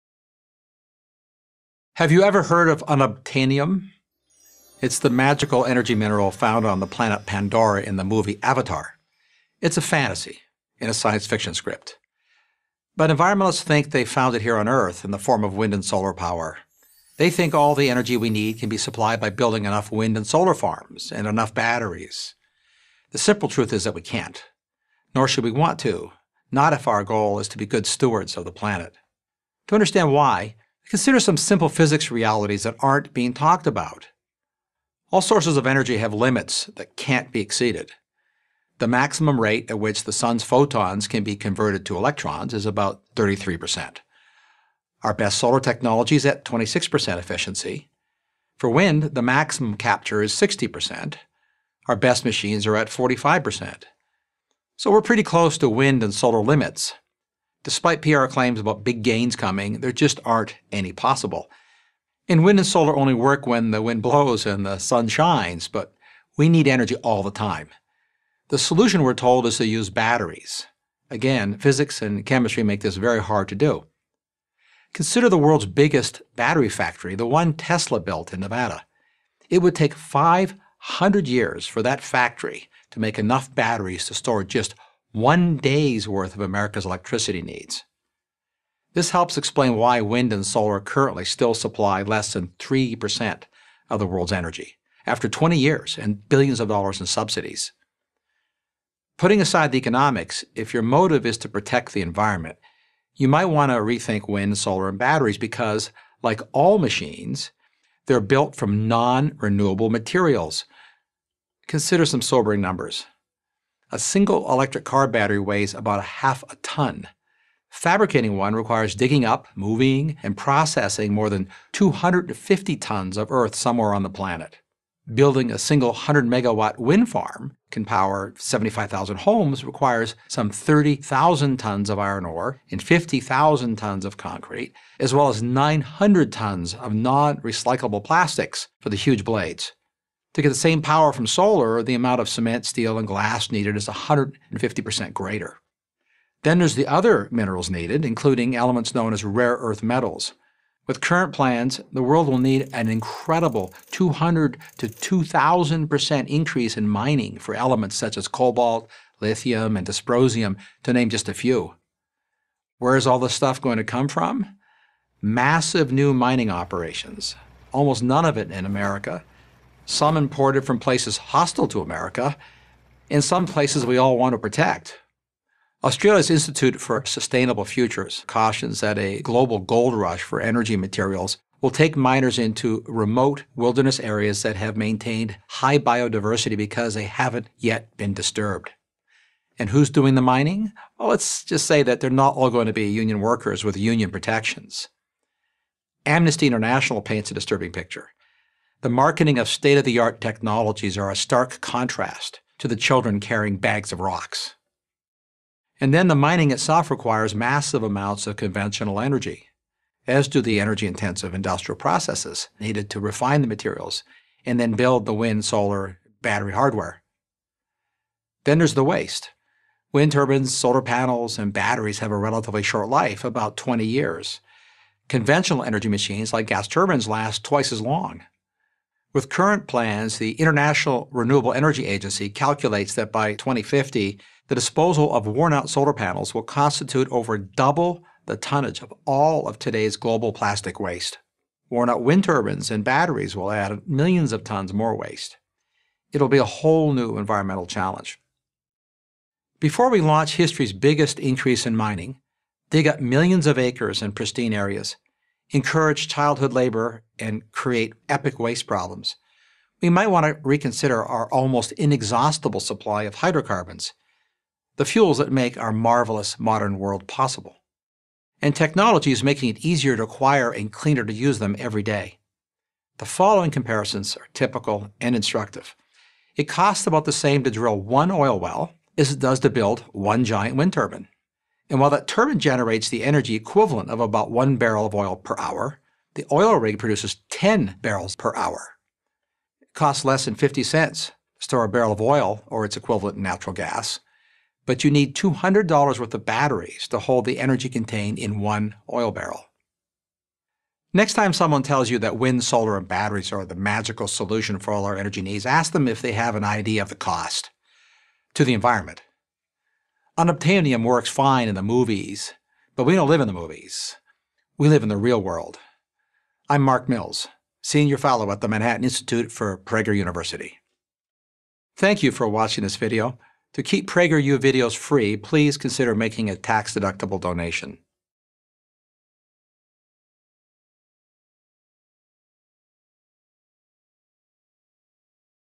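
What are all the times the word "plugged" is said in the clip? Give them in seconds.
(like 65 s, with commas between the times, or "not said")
not said.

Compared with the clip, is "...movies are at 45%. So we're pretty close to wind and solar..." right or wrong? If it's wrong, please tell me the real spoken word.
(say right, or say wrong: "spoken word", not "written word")
wrong: "machines", not "movies".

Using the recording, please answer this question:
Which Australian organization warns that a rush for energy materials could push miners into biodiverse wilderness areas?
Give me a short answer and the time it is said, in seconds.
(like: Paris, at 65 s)
Institute for Sustainable Futures, at 176 s.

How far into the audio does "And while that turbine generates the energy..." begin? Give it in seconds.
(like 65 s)
281 s.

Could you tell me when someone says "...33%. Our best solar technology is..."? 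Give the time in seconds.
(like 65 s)
43 s.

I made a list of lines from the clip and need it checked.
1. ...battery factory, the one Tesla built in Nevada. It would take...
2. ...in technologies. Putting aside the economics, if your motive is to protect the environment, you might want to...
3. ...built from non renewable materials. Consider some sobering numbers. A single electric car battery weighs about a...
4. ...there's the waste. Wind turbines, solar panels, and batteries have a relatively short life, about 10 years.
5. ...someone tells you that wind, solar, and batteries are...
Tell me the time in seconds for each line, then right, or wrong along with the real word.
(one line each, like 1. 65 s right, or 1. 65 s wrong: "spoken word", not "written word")
1. 76 s right
2. 96 s wrong: "subsidies", not "technologies"
3. 108 s right
4. 218 s wrong: "20", not "10"
5. 301 s right.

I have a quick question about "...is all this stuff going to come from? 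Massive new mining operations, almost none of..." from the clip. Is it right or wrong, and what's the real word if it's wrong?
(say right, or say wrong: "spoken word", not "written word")
right.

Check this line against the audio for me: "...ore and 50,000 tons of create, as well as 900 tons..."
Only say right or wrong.
wrong.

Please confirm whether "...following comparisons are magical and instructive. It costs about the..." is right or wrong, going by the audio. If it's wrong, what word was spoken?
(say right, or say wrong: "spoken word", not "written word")
wrong: "typical", not "magical".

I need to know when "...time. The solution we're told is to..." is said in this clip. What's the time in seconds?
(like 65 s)
67 s.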